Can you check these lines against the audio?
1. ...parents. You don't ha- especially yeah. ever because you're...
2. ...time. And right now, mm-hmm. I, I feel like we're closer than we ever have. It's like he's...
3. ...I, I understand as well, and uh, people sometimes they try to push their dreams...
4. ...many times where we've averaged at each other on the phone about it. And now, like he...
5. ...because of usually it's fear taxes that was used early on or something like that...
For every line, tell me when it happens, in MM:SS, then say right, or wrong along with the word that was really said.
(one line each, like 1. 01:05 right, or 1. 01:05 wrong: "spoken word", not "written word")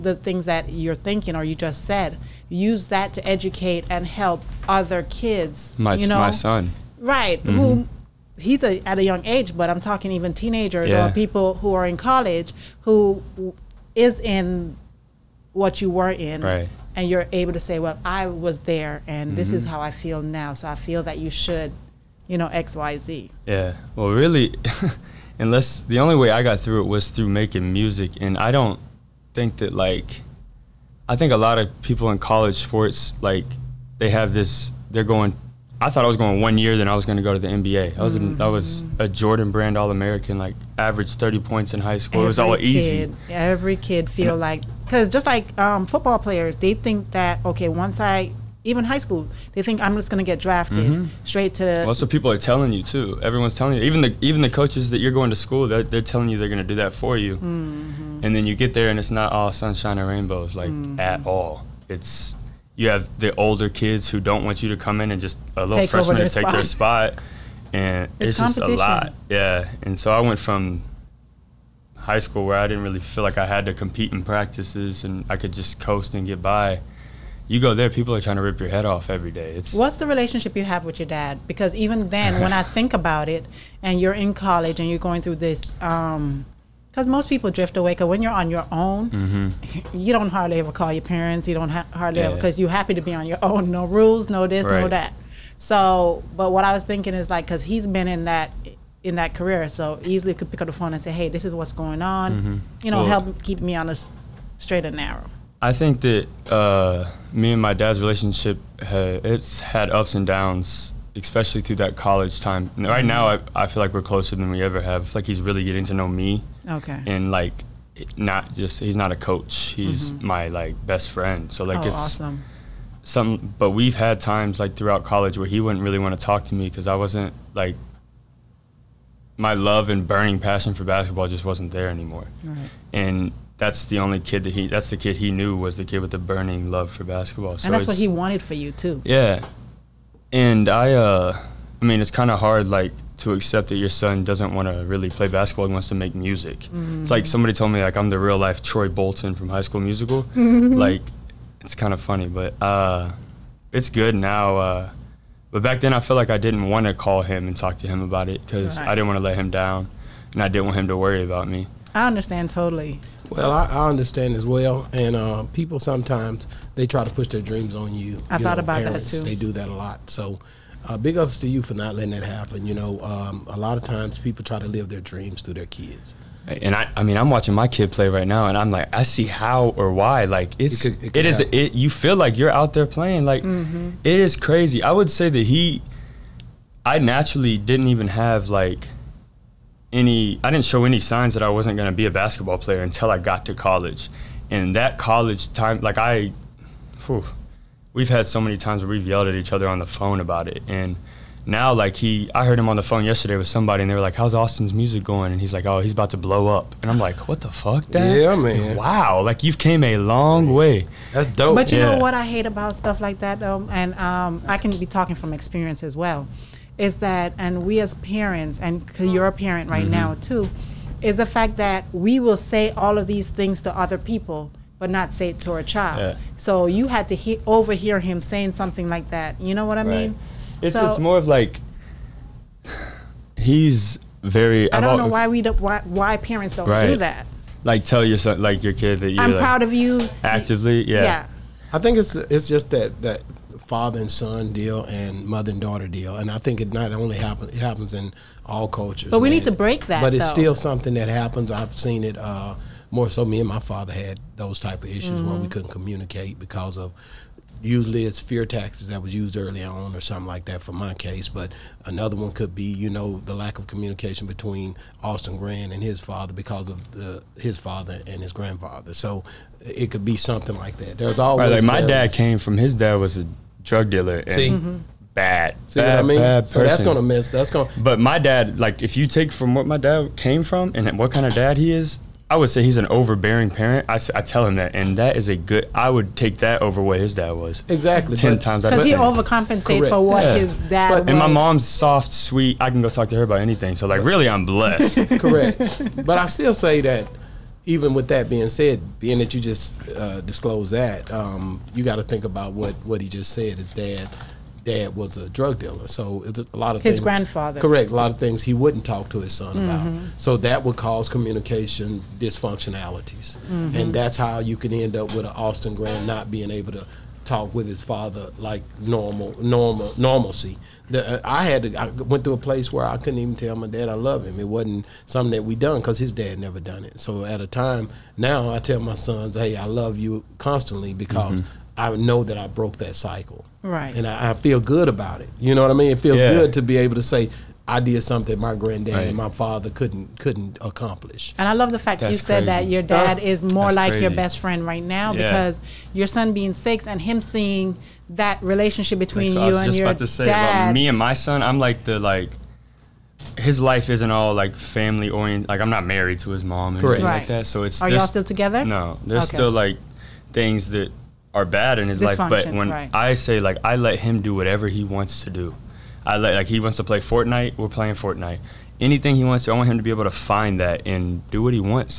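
1. 01:31 wrong: "hardly", not "especially"
2. 01:52 right
3. 02:43 right
4. 03:18 wrong: "yelled", not "averaged"
5. 04:16 right.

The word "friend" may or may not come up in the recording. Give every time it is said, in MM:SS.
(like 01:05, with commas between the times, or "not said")
02:01, 05:44.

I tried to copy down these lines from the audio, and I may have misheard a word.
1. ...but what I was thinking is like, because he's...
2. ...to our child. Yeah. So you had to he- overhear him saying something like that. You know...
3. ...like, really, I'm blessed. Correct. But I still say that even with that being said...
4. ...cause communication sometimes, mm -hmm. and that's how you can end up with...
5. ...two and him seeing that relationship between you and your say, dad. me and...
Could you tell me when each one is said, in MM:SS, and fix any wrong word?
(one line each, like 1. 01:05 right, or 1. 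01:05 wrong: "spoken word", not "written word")
1. 01:36 right
2. 03:45 right
3. 04:53 right
4. 05:10 wrong: "dysfunctionalities", not "sometimes"
5. 05:46 wrong: "six", not "two".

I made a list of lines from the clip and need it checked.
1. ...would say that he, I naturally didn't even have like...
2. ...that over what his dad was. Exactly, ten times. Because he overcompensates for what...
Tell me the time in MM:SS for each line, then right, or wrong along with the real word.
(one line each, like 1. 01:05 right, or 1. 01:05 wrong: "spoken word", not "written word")
1. 03:04 right
2. 04:46 right.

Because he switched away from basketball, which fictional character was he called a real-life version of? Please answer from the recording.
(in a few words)
Troy Bolton.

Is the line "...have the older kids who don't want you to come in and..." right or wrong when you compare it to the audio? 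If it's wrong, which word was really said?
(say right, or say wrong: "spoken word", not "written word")
right.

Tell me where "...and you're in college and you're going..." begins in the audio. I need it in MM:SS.
01:23.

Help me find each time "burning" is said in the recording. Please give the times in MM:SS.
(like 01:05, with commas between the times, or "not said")
02:10, 02:16.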